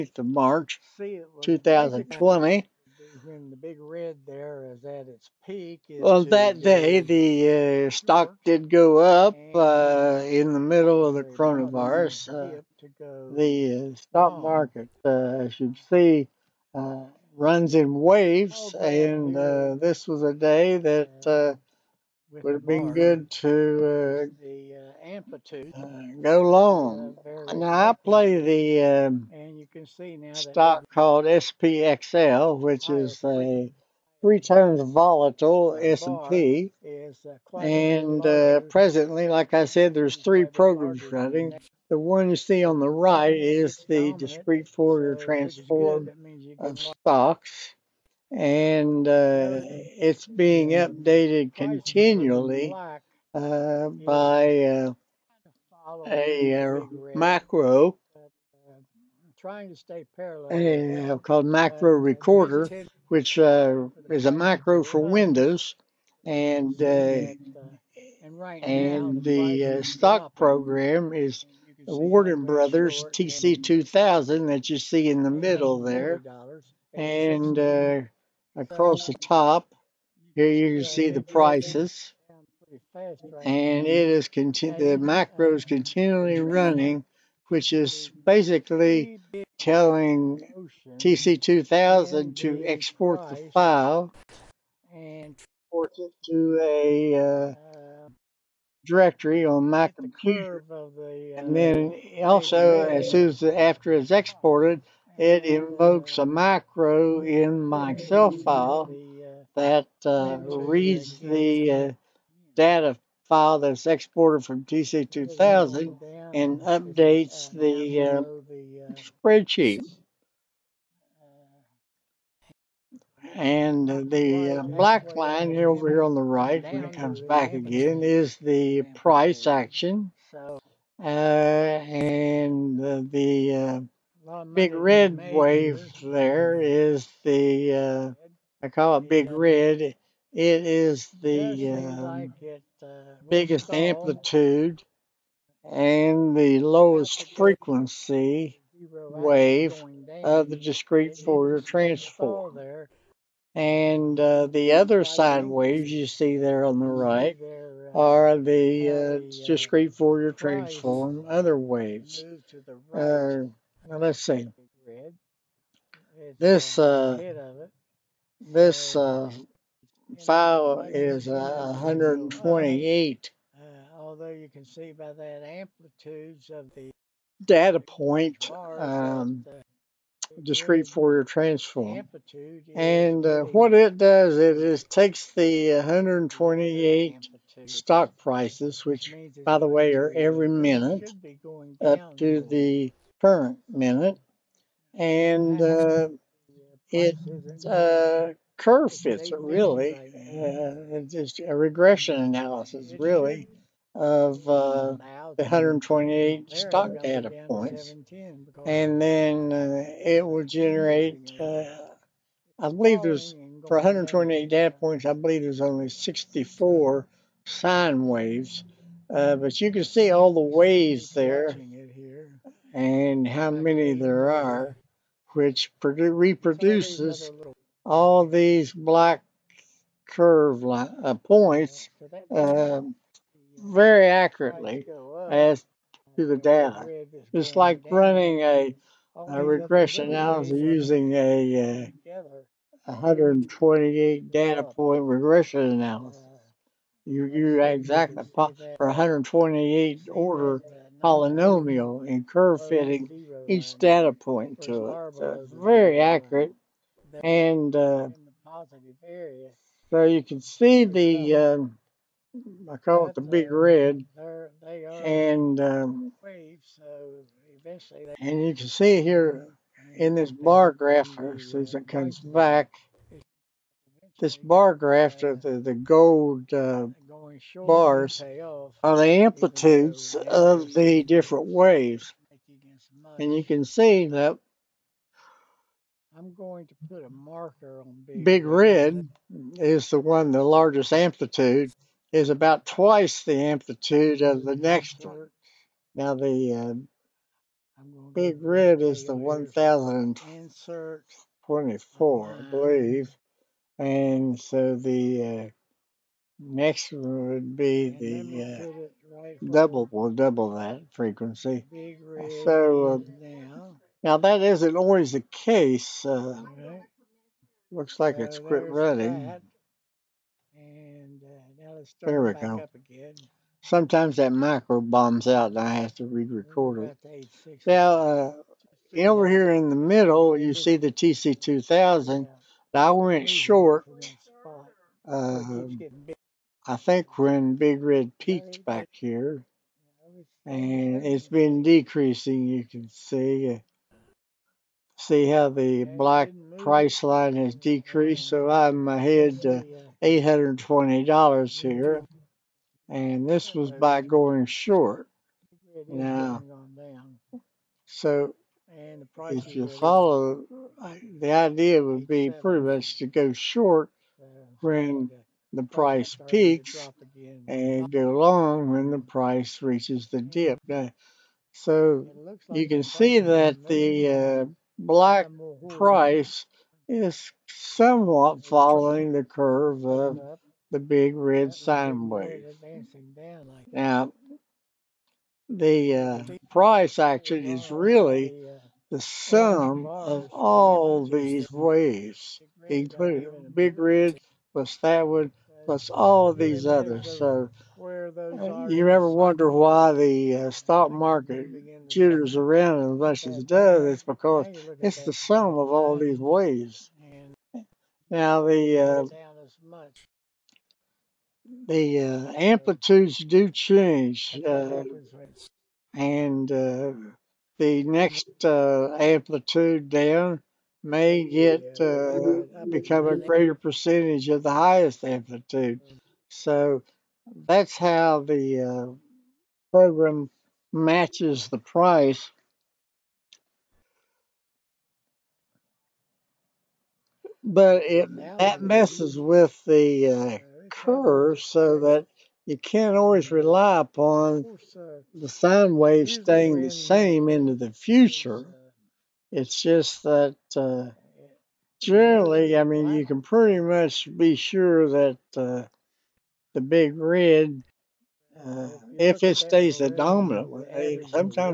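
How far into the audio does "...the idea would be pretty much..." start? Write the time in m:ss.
6:01.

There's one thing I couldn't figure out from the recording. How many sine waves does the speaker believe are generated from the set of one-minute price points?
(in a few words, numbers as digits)
64.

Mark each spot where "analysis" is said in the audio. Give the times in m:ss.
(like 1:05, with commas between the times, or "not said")
3:22, 4:00, 4:05.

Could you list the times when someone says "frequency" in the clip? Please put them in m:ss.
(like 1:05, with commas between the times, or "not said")
2:27, 5:10.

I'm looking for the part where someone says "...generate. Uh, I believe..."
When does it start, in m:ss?
3:30.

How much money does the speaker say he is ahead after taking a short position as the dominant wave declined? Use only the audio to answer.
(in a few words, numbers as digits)
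$820.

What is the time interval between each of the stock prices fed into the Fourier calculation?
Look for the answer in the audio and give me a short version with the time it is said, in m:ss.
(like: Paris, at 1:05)
every minute, at 3:10.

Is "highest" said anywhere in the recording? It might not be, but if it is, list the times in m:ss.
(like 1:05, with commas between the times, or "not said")
7:04.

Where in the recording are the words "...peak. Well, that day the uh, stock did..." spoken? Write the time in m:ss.
0:05.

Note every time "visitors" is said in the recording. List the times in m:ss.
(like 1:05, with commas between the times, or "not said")
not said.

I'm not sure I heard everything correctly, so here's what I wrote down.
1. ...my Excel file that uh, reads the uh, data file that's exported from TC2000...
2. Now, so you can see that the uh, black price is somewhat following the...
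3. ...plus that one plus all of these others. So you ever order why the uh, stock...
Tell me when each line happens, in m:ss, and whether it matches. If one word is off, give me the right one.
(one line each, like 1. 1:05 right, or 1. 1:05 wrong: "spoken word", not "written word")
1. 1:47 right
2. 6:10 right
3. 6:34 wrong: "wonder", not "order".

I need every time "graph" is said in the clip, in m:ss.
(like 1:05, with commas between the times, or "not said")
4:30, 4:34.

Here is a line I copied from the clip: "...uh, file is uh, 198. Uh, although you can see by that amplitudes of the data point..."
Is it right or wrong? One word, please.
wrong.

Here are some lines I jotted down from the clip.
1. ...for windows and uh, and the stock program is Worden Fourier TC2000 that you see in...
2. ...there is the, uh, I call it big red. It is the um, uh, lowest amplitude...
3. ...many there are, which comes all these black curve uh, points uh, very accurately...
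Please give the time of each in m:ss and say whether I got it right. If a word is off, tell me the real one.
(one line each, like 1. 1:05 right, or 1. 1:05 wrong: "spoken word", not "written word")
1. 1:04 wrong: "Brothers", not "Fourier"
2. 2:16 wrong: "biggest", not "lowest"
3. 3:43 wrong: "reproduces", not "comes".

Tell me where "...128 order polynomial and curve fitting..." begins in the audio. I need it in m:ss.
4:08.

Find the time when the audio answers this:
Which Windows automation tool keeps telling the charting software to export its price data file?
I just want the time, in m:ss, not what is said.
1:01.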